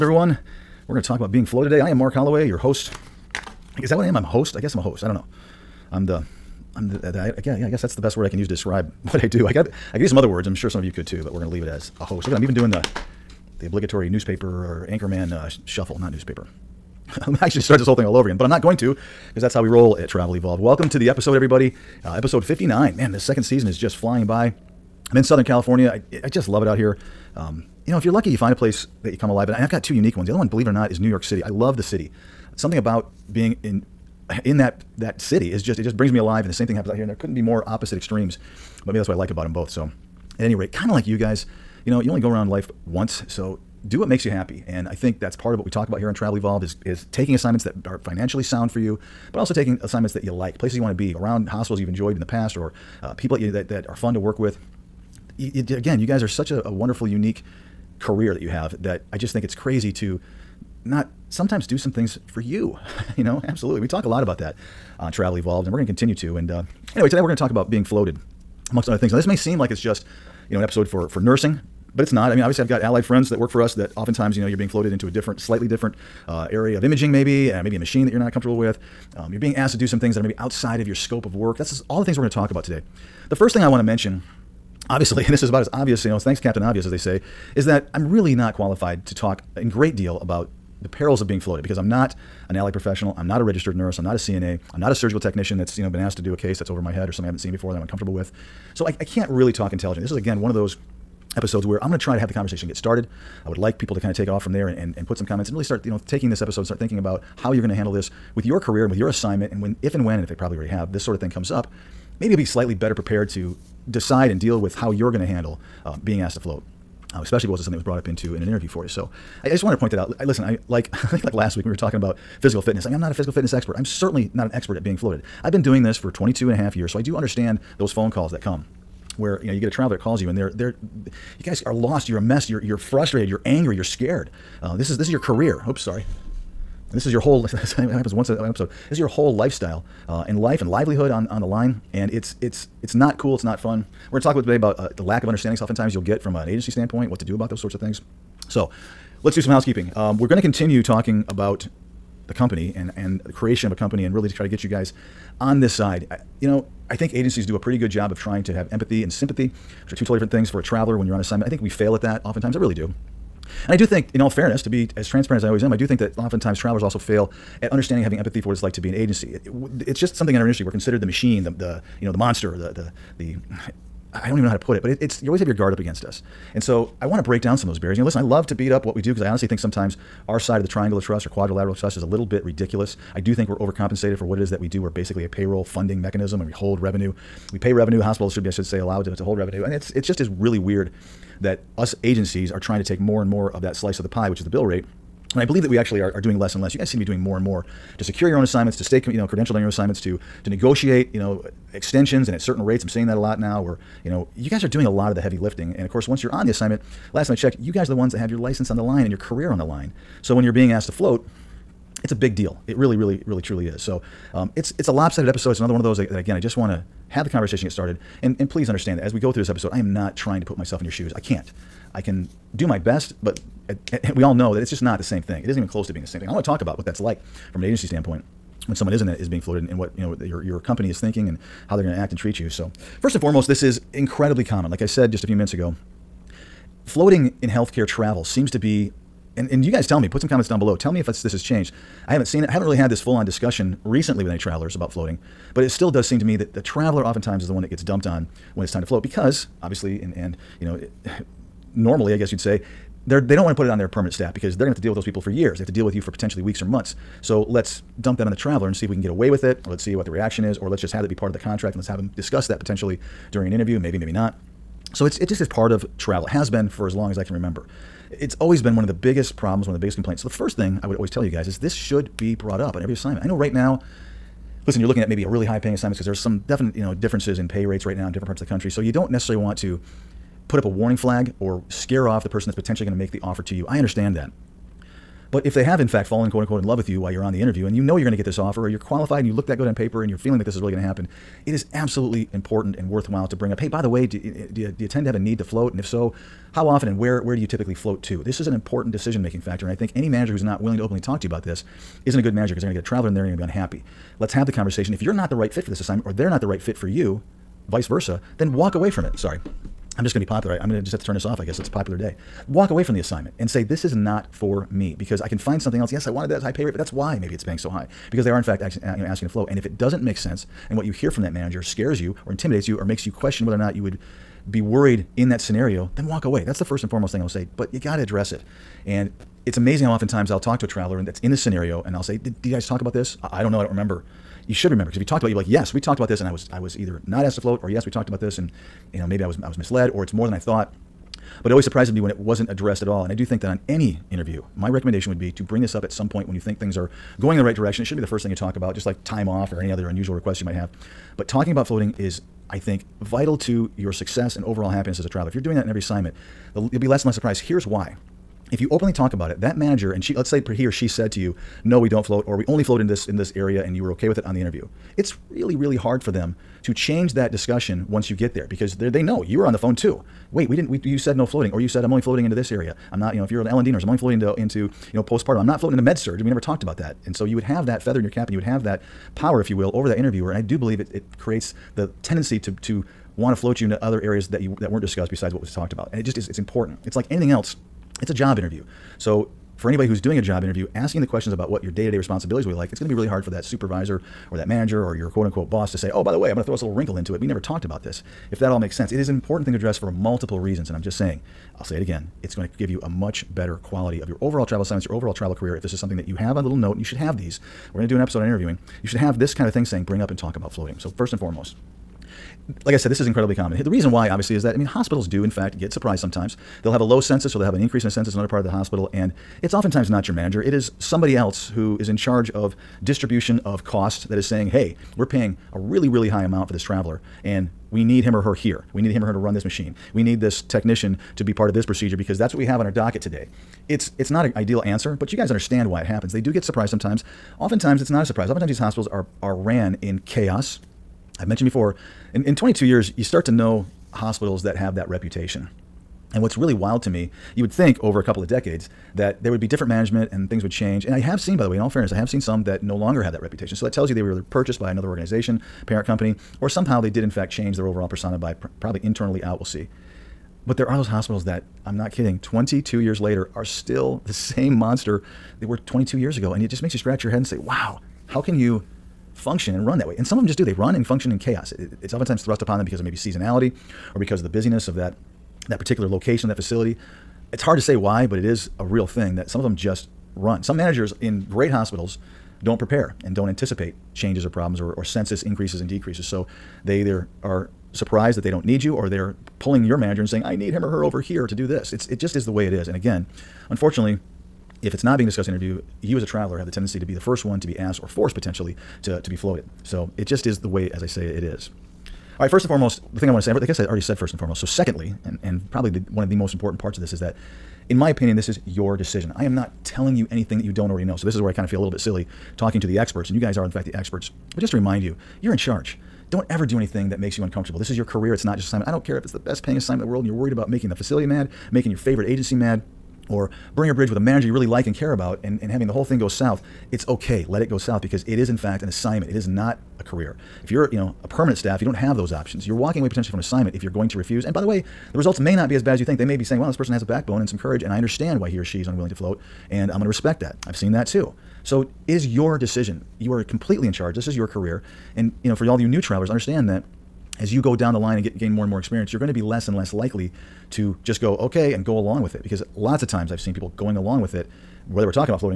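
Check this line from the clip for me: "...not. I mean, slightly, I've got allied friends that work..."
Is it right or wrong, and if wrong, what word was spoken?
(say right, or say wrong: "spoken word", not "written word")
wrong: "obviously", not "slightly".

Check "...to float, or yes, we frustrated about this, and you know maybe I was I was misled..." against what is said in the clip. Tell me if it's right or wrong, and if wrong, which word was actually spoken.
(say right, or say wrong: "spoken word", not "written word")
wrong: "talked", not "frustrated".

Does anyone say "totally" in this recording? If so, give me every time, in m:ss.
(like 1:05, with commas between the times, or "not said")
2:40.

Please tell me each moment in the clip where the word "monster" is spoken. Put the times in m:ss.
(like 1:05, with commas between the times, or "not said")
2:52, 7:44.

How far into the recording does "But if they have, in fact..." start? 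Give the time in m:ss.
4:45.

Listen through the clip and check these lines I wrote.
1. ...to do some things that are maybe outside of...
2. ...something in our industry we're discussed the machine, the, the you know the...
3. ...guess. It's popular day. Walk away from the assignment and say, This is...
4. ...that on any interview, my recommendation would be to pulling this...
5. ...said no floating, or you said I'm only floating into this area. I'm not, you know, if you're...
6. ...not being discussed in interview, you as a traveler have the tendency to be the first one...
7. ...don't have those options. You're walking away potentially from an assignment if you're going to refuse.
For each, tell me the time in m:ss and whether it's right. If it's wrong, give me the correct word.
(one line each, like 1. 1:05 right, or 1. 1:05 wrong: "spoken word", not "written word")
1. 1:19 right
2. 2:50 wrong: "considered", not "discussed"
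3. 5:11 right
4. 5:43 wrong: "bring", not "pulling"
5. 6:10 right
6. 8:14 right
7. 8:51 right.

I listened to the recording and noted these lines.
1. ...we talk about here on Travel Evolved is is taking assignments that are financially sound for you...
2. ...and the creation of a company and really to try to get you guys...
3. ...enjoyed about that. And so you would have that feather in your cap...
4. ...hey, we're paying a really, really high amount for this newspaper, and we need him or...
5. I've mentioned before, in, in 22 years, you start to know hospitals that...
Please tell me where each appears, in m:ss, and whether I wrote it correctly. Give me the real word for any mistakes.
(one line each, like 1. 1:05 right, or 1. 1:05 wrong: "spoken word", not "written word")
1. 0:45 right
2. 2:32 right
3. 6:16 wrong: "talked", not "enjoyed"
4. 7:04 wrong: "traveler", not "newspaper"
5. 7:21 right.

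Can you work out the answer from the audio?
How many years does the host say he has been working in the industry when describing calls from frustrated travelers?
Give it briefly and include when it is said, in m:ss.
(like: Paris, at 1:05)
22 and a half, at 2:06.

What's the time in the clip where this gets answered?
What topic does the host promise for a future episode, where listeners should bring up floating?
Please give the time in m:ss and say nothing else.
6:48.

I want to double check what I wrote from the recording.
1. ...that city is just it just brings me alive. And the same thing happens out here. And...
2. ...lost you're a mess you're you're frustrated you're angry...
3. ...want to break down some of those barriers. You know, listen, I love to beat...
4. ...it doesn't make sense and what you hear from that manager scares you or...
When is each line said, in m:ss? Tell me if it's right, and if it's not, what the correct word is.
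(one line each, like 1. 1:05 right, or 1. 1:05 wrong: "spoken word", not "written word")
1. 0:34 right
2. 2:11 right
3. 2:57 right
4. 5:19 right.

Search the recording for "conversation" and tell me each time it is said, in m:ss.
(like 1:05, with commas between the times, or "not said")
1:42, 3:37, 5:04.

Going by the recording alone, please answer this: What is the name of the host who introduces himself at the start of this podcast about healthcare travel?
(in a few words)
Mark Holloway.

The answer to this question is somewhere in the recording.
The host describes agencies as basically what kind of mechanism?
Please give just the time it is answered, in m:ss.
3:05.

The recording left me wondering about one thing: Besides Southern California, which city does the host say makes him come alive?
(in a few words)
New York City.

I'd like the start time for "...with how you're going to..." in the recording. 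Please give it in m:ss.
1:54.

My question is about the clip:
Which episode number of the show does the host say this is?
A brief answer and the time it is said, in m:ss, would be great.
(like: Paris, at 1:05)
59, at 0:22.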